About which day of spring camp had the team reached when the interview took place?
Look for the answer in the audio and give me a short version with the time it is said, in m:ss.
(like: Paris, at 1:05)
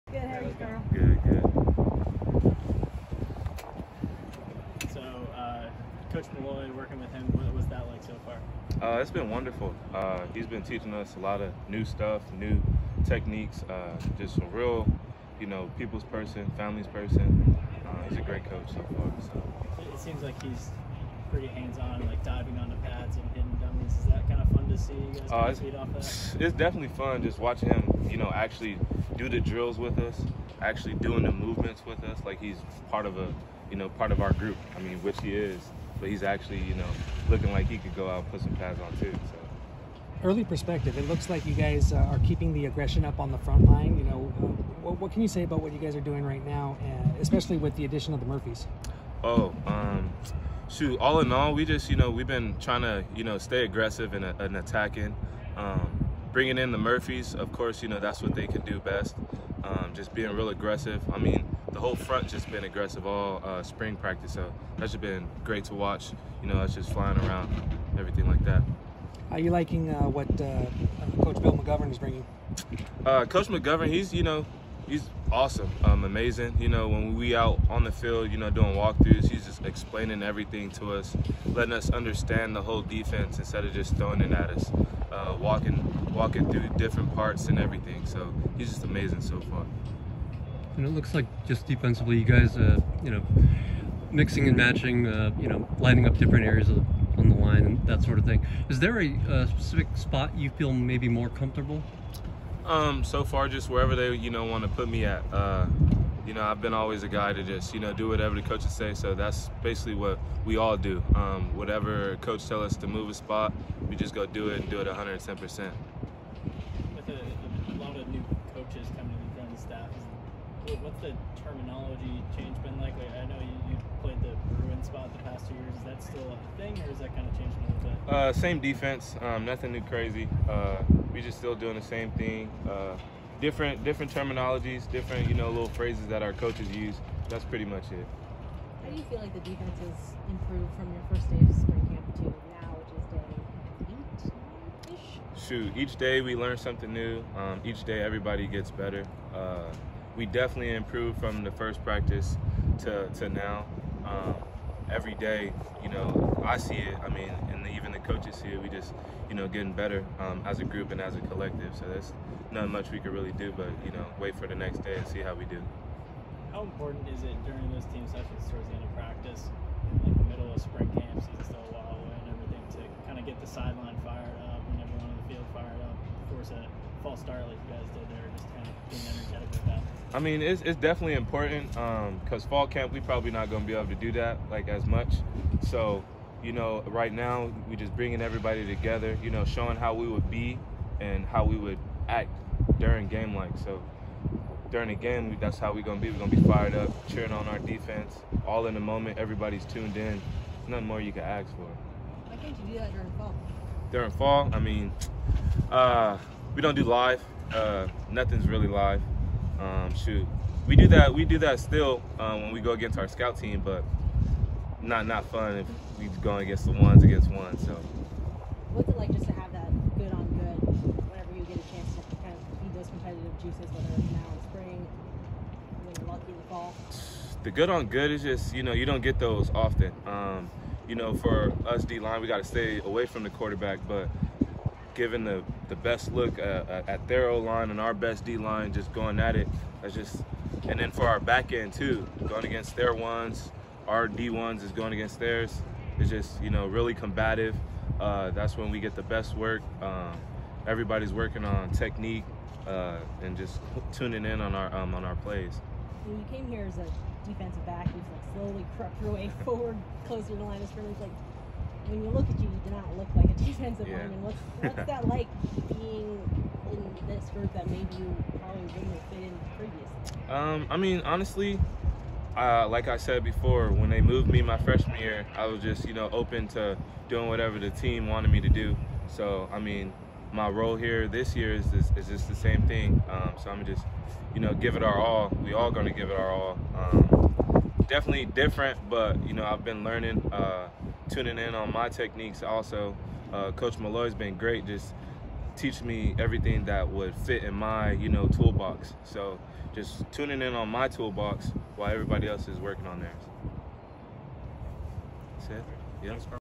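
Day 8, at 2:24.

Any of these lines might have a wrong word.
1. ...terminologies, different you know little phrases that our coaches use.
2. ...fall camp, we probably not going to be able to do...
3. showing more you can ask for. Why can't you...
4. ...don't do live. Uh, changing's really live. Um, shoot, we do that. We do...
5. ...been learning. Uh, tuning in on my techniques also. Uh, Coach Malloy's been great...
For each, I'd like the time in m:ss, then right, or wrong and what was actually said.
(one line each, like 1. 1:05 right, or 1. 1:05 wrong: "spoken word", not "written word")
1. 2:14 right
2. 3:02 right
3. 3:20 wrong: "nothing", not "showing"
4. 3:26 wrong: "nothing", not "changing"
5. 4:49 right.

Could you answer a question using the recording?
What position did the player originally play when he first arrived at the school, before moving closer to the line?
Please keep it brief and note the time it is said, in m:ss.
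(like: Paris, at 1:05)
Defensive back, at 4:17.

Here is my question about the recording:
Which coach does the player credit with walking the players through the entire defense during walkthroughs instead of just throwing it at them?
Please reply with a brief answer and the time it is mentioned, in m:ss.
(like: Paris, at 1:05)
Bill McGovern, at 1:11.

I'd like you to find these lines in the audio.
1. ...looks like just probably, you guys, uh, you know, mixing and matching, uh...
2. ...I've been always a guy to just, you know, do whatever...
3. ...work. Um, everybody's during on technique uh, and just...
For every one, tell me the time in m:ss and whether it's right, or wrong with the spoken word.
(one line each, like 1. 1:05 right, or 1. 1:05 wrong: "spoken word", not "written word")
1. 1:30 wrong: "defensively", not "probably"
2. 1:46 right
3. 4:09 wrong: "working", not "during".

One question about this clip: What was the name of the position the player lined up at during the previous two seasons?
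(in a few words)
Bruin.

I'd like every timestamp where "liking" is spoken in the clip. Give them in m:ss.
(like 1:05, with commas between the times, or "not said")
1:09.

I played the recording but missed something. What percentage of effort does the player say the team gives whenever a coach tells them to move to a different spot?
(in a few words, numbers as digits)
110%.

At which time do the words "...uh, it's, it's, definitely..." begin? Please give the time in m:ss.
0:25.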